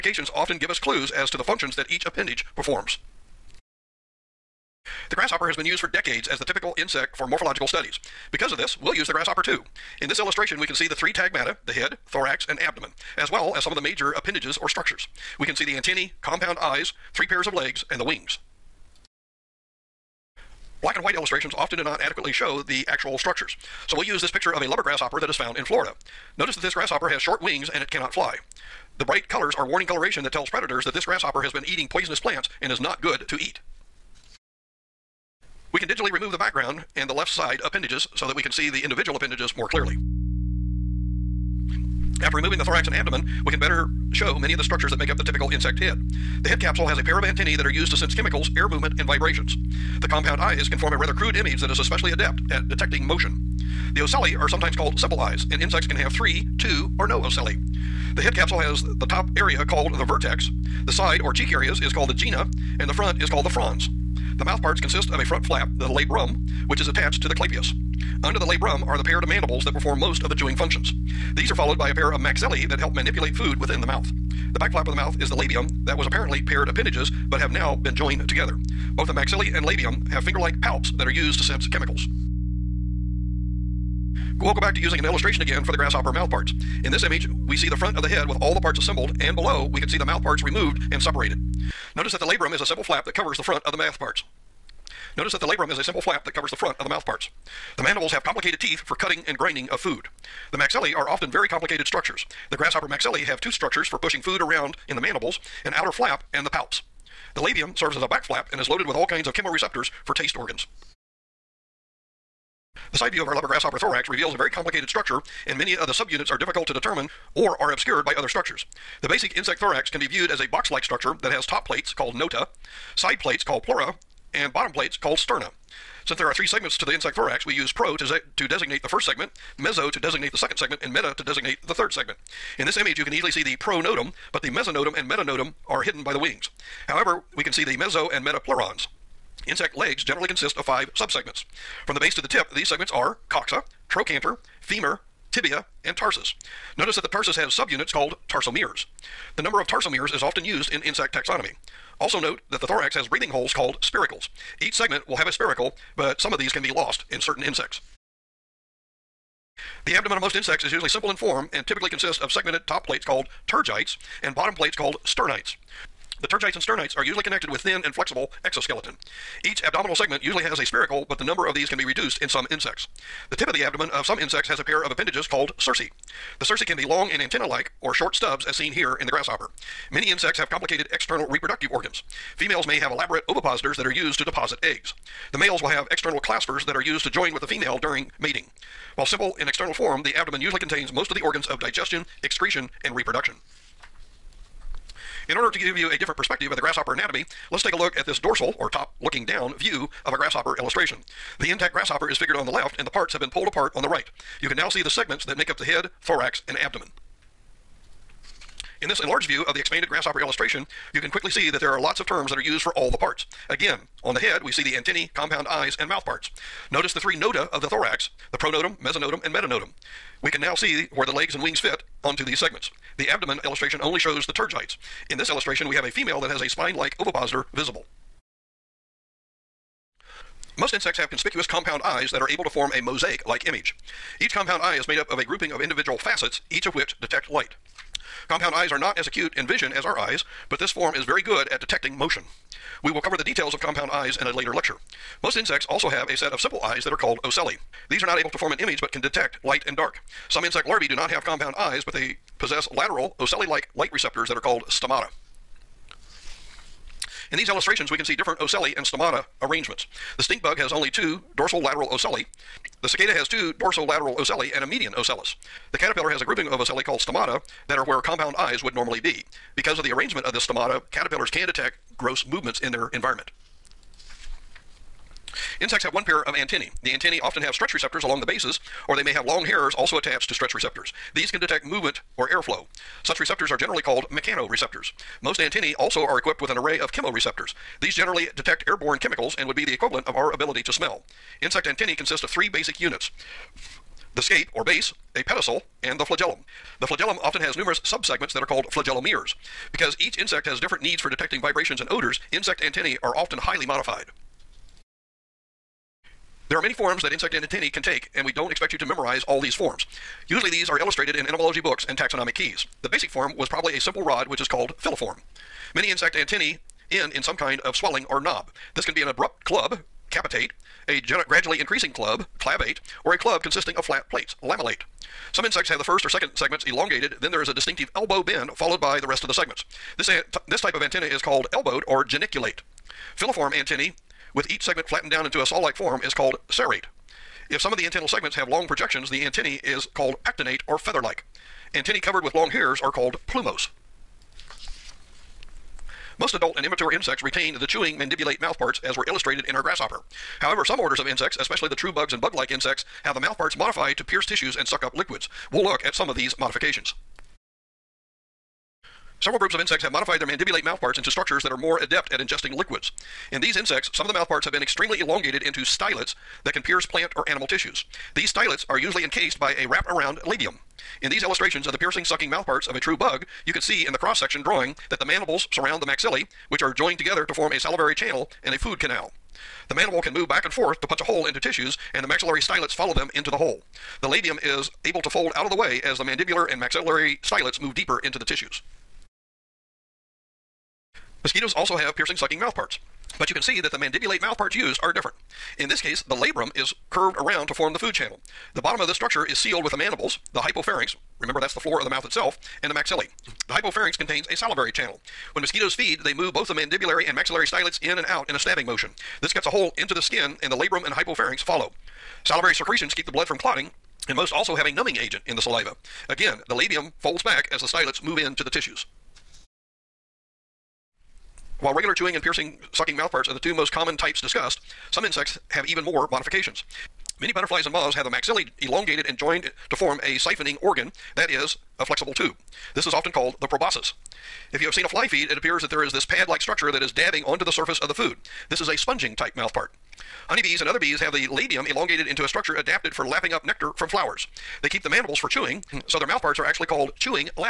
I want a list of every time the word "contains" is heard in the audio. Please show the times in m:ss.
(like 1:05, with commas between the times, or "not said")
3:10, 6:43.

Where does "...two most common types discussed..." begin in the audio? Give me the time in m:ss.
7:03.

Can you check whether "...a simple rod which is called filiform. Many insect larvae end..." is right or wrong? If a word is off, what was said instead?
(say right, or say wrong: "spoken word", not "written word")
wrong: "antennae", not "larvae".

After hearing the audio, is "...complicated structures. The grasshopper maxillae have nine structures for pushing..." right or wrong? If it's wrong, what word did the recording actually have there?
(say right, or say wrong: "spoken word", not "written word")
wrong: "two", not "nine".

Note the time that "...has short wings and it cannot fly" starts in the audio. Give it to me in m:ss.
0:27.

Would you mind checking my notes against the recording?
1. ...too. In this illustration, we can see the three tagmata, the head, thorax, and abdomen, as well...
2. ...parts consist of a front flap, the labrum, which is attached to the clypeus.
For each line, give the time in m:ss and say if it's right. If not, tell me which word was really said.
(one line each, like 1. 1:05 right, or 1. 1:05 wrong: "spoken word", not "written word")
1. 0:09 right
2. 1:04 right.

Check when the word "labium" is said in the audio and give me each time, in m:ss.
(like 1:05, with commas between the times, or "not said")
1:15, 1:19, 1:47, 6:10, 6:24, 6:56, 7:21.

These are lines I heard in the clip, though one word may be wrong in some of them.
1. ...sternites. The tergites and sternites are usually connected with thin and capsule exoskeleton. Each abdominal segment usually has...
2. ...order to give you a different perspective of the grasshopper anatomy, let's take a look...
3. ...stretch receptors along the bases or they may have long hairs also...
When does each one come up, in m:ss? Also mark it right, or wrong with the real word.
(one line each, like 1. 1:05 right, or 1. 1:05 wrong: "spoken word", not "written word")
1. 2:45 wrong: "flexible", not "capsule"
2. 3:15 right
3. 4:37 right.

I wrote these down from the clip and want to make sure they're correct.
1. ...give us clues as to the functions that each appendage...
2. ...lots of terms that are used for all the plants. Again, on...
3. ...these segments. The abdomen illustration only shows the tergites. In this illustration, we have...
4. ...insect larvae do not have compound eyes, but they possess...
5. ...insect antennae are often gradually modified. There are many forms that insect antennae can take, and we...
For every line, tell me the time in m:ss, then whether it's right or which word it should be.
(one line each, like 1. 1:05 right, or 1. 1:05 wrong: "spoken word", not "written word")
1. 0:00 right
2. 3:31 wrong: "parts", not "plants"
3. 3:42 right
4. 4:10 right
5. 5:02 wrong: "highly", not "gradually".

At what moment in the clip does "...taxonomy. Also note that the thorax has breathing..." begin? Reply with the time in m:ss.
2:31.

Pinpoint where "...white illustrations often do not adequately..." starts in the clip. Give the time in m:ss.
0:21.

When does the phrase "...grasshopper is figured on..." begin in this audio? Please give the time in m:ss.
3:21.